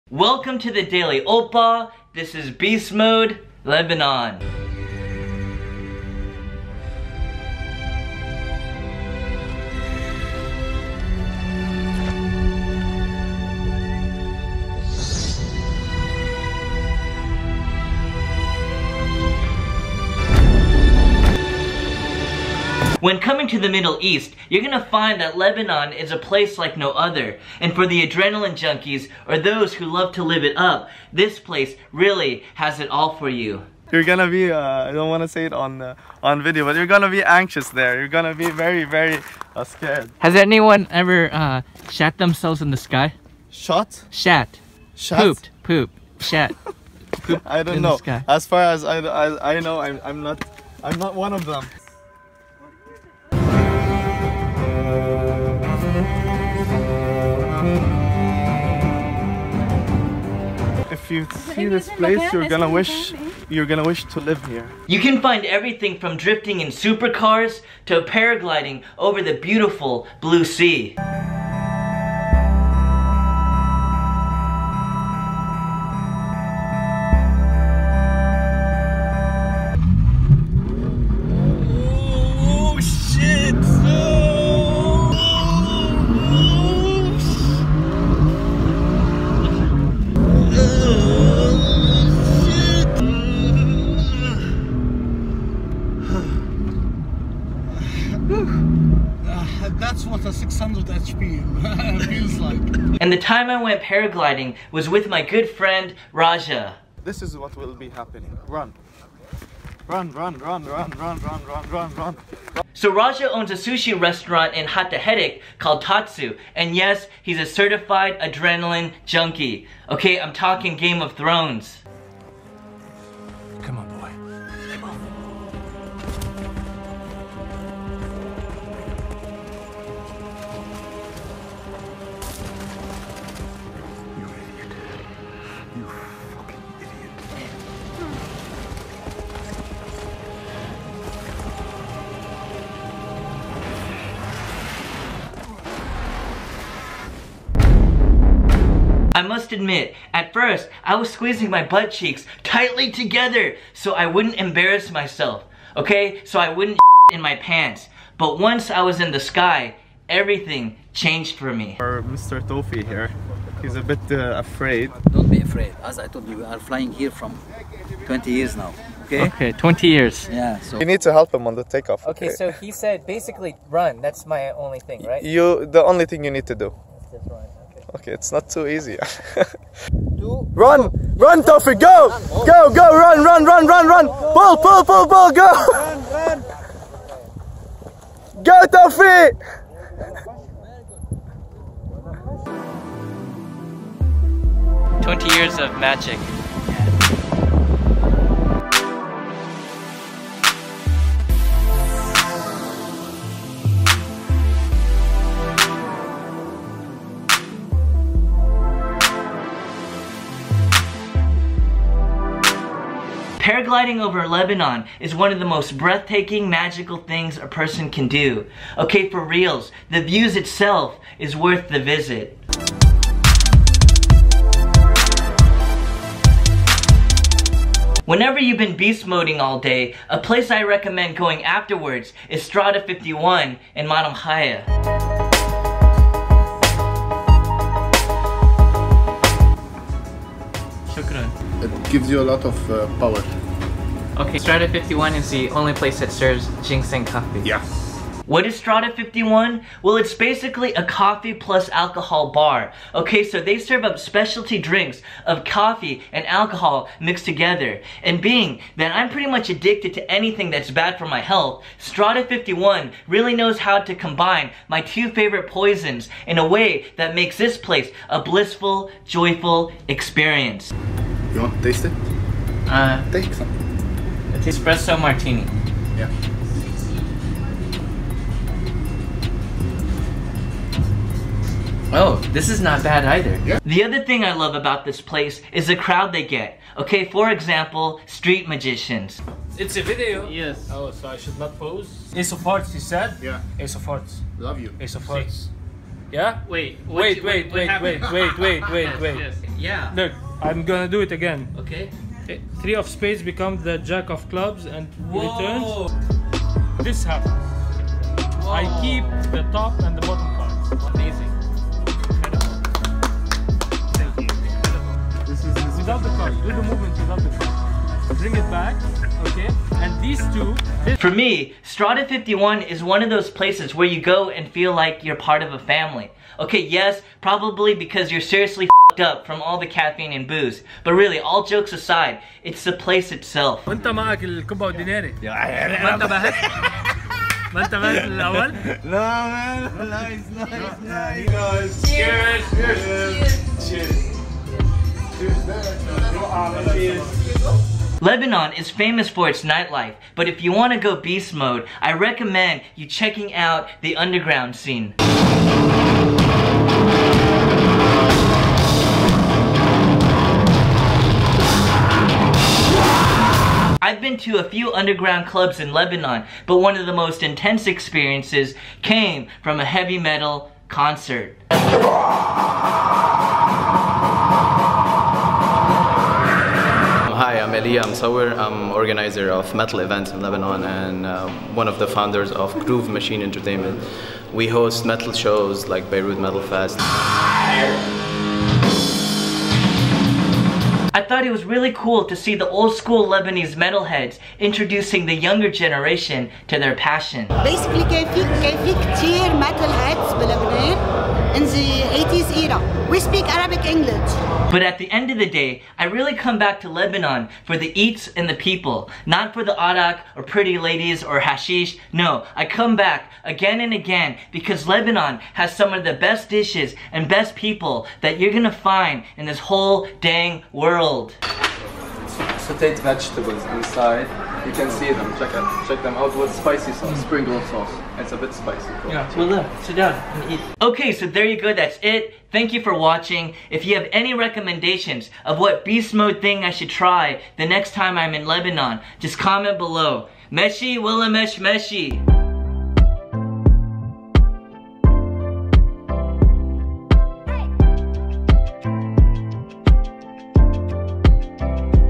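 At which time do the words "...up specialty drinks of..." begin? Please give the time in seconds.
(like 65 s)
253 s.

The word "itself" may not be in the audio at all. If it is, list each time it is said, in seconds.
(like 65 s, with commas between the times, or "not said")
220 s, 333 s.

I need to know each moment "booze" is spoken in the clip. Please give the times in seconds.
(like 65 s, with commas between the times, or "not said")
330 s.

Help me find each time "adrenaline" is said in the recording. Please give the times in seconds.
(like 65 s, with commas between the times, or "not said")
28 s, 118 s.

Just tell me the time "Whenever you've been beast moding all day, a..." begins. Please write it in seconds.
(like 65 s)
228 s.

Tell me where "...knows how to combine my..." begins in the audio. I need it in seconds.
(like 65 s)
263 s.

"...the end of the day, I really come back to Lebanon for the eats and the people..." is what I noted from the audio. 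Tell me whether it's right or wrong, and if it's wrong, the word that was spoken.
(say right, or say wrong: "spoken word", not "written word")
right.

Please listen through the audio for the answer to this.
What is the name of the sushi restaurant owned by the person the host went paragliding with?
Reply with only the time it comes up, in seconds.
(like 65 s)
115 s.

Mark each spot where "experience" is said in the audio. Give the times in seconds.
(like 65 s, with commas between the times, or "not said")
269 s, 367 s.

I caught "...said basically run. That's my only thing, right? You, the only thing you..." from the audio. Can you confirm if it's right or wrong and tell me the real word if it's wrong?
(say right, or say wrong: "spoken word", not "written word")
right.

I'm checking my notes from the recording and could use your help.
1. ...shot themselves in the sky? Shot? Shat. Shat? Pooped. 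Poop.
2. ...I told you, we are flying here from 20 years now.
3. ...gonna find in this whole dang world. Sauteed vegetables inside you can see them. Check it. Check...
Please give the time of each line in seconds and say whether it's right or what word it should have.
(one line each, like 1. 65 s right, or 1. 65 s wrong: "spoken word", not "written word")
1. 41 s right
2. 165 s right
3. 418 s right.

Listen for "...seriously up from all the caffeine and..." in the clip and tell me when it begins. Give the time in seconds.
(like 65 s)
328 s.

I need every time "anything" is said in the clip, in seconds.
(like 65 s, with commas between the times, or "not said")
260 s.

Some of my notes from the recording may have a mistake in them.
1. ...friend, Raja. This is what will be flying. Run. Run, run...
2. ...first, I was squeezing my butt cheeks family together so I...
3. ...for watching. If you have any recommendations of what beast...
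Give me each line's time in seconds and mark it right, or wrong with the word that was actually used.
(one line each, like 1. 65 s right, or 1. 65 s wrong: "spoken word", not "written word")
1. 105 s wrong: "happening", not "flying"
2. 150 s wrong: "tightly", not "family"
3. 432 s right.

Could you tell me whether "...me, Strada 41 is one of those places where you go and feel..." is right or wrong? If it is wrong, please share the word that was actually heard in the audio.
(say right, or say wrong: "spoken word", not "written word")
wrong: "51", not "41".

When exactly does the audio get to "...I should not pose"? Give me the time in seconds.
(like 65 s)
291 s.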